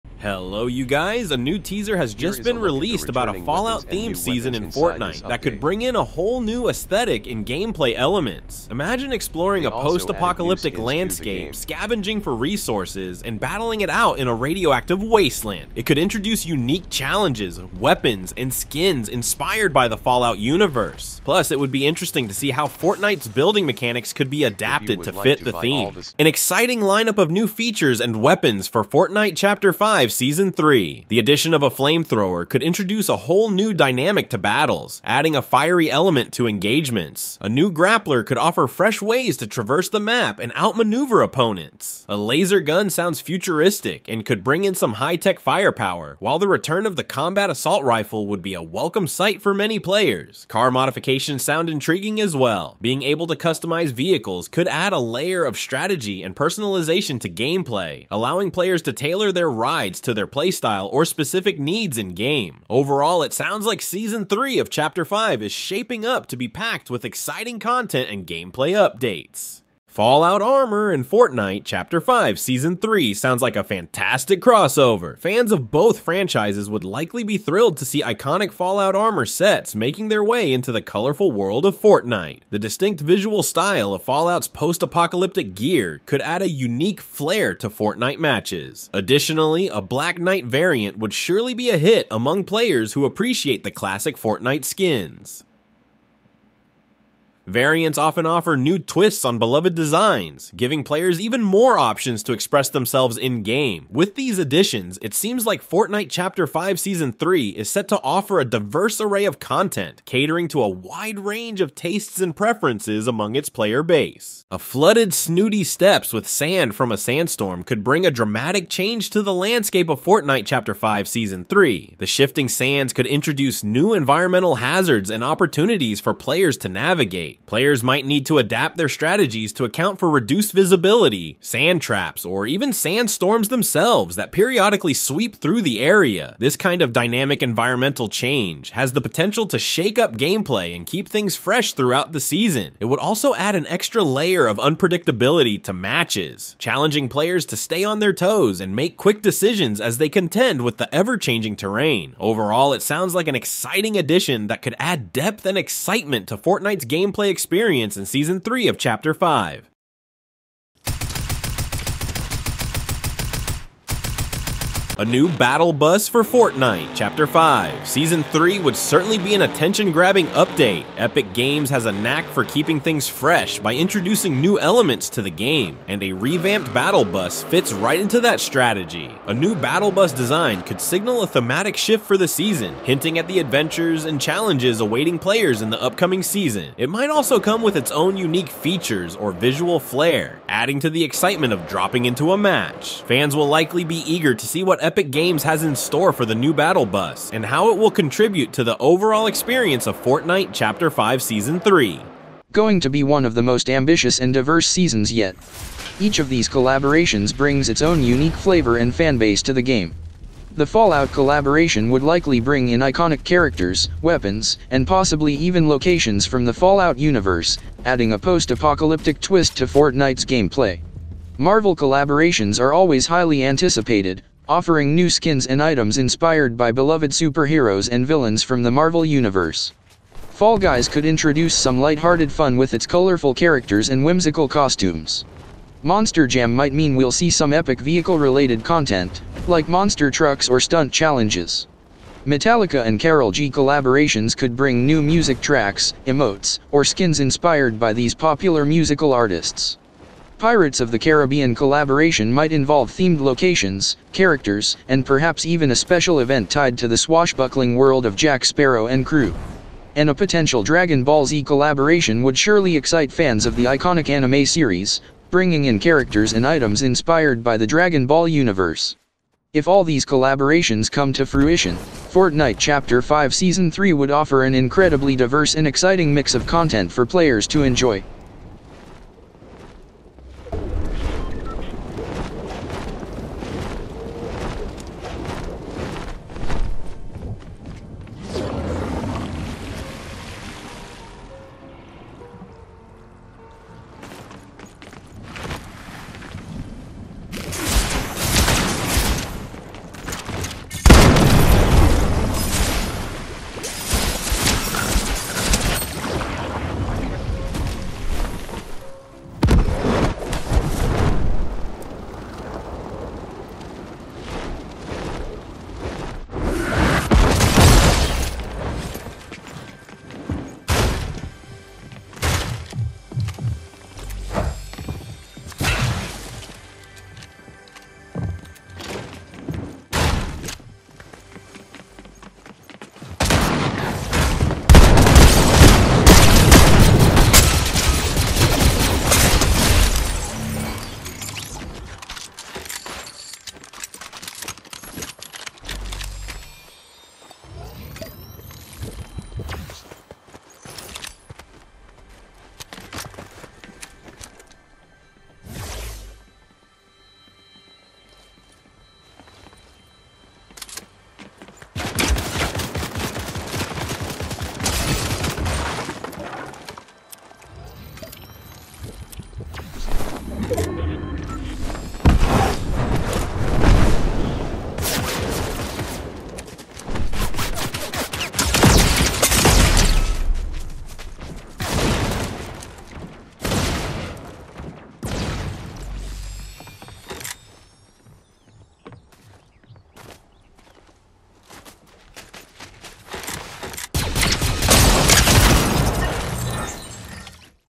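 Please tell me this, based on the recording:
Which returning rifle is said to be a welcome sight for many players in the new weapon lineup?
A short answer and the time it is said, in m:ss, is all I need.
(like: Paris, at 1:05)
Combat assault rifle, at 0:47.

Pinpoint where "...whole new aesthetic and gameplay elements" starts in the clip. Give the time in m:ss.
0:06.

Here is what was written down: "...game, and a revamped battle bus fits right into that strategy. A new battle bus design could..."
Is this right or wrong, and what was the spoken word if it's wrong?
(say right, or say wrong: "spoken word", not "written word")
right.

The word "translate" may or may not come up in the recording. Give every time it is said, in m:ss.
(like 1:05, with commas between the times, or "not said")
not said.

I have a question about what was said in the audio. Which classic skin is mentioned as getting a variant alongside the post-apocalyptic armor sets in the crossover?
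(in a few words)
Black Knight.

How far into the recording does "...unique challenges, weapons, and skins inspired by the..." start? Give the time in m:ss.
0:16.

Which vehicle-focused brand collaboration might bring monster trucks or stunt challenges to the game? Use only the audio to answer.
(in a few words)
Monster Jam.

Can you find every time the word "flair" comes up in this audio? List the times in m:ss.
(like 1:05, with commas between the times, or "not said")
1:27, 3:09.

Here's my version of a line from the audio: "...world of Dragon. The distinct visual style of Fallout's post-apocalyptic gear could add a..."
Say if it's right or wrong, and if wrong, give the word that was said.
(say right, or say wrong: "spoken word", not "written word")
wrong: "Fortnite", not "Dragon".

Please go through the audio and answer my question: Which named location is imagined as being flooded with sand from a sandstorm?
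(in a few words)
Snooty Steps.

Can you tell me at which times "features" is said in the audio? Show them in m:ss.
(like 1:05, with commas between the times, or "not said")
0:27, 3:08.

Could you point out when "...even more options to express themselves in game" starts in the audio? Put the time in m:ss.
1:41.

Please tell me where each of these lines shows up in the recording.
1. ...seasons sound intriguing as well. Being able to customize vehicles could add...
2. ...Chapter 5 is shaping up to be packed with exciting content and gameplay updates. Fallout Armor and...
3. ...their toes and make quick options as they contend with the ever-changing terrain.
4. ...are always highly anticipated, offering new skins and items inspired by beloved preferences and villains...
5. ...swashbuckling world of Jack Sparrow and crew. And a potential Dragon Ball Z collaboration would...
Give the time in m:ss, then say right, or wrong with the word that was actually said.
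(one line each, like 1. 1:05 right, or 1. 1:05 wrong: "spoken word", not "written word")
1. 0:50 wrong: "modifications", not "seasons"
2. 1:04 right
3. 2:27 wrong: "decisions", not "options"
4. 3:42 wrong: "superheroes", not "preferences"
5. 4:16 right.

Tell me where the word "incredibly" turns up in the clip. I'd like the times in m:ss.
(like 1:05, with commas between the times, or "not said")
4:34.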